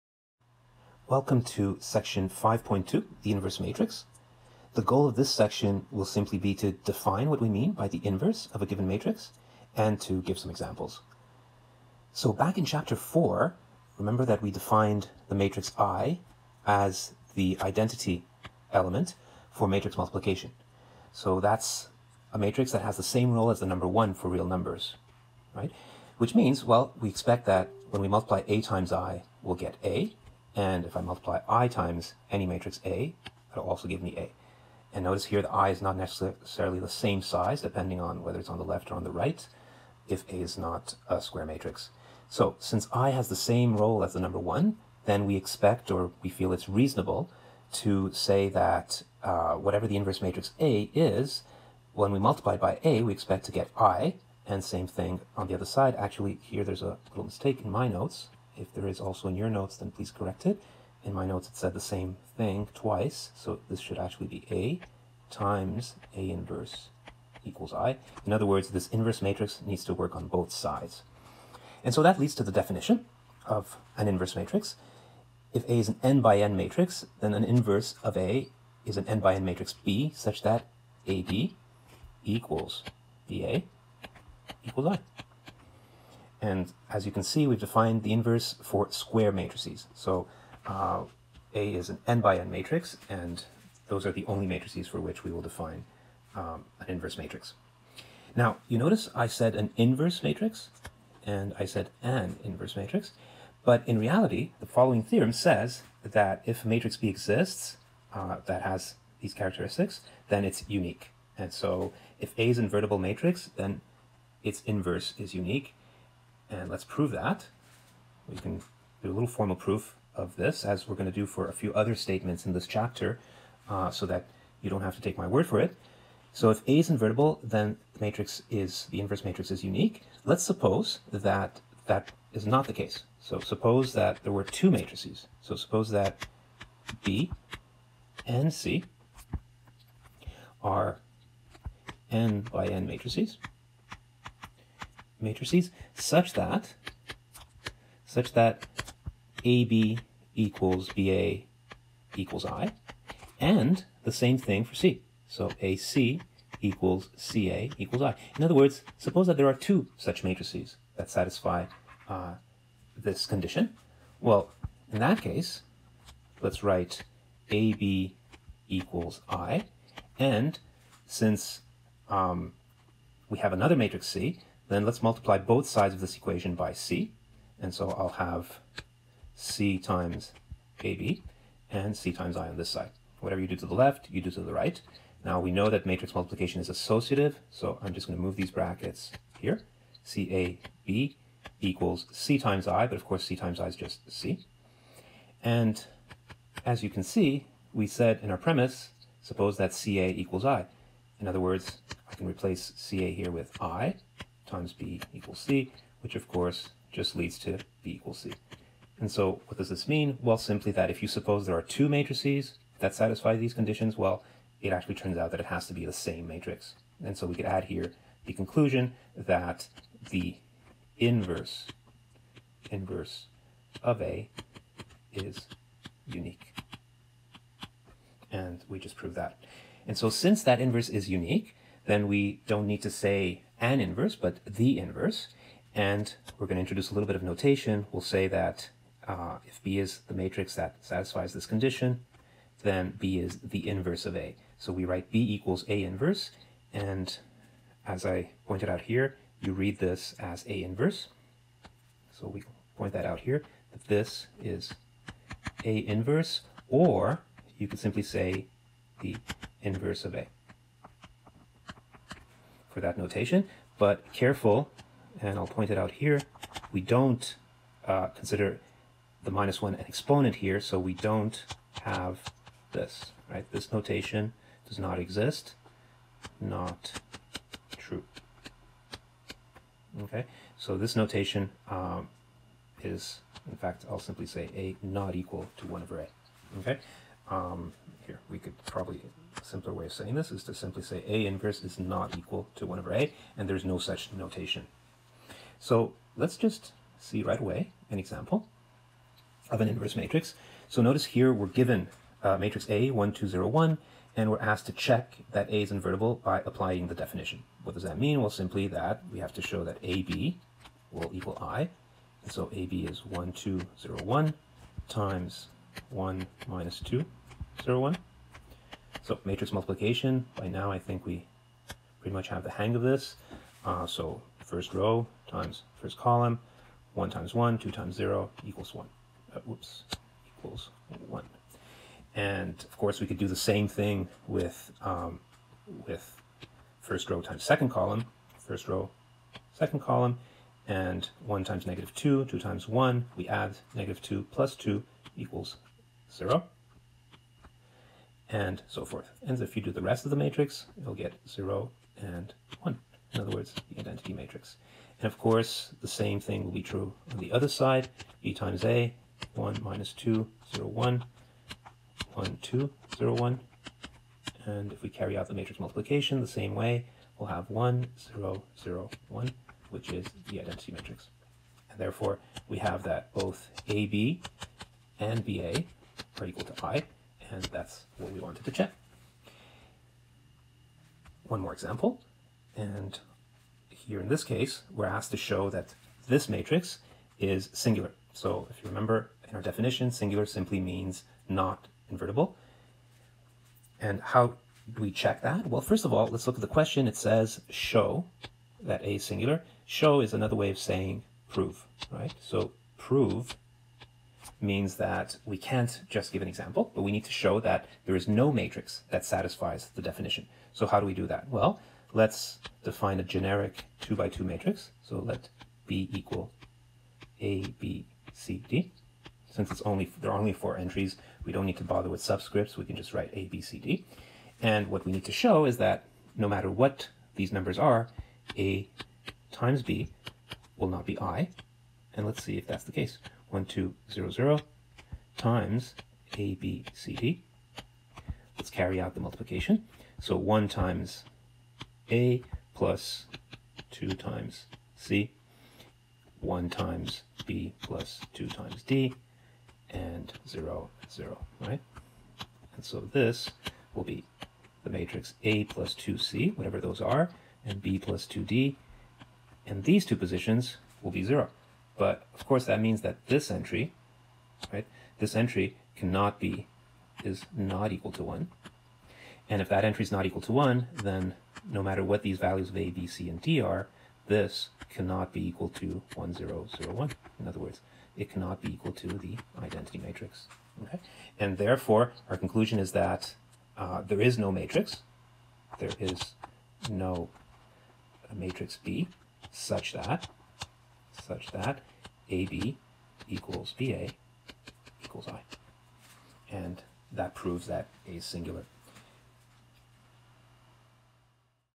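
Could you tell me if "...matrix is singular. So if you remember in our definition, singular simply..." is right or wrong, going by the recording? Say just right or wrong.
right.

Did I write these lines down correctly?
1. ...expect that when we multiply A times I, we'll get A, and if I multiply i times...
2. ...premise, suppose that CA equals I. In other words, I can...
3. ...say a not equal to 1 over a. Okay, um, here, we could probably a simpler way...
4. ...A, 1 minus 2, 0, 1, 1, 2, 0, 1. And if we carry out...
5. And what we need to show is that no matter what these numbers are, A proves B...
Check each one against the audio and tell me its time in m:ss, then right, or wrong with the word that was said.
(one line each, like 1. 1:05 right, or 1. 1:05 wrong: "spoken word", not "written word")
1. 0:27 right
2. 3:18 right
3. 4:44 right
4. 5:58 right
5. 7:04 wrong: "times", not "proves".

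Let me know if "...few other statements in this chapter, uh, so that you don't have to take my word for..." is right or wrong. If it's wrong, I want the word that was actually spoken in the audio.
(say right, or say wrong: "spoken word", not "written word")
right.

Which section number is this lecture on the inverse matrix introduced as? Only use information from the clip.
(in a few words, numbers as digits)
5.2.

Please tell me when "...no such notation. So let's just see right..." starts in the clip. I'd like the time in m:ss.
4:53.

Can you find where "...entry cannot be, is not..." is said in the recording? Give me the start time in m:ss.
7:45.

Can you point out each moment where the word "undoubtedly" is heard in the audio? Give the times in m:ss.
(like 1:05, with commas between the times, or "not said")
not said.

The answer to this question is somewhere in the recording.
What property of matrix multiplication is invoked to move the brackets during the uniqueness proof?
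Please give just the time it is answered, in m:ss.
3:06.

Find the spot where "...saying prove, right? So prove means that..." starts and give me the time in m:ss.
6:40.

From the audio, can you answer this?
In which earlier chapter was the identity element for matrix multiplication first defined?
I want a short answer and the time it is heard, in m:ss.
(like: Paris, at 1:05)
chapter 4, at 0:12.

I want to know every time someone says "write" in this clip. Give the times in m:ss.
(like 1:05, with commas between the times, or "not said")
2:46, 4:04, 7:02.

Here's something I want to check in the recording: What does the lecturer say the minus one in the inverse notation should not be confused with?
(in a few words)
an exponent.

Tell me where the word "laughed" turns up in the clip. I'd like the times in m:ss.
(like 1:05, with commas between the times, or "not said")
not said.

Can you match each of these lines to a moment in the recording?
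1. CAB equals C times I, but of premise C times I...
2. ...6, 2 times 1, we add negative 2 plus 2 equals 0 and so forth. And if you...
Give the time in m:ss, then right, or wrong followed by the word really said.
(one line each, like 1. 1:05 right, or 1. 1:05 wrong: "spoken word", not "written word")
1. 3:10 wrong: "course", not "premise"
2. 5:41 wrong: "2", not "6".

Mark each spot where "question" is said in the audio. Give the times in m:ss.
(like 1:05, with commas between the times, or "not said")
6:36.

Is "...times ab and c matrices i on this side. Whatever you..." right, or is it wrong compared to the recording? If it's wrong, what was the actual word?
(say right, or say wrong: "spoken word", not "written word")
wrong: "times", not "matrices".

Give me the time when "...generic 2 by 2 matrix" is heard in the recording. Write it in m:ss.
6:53.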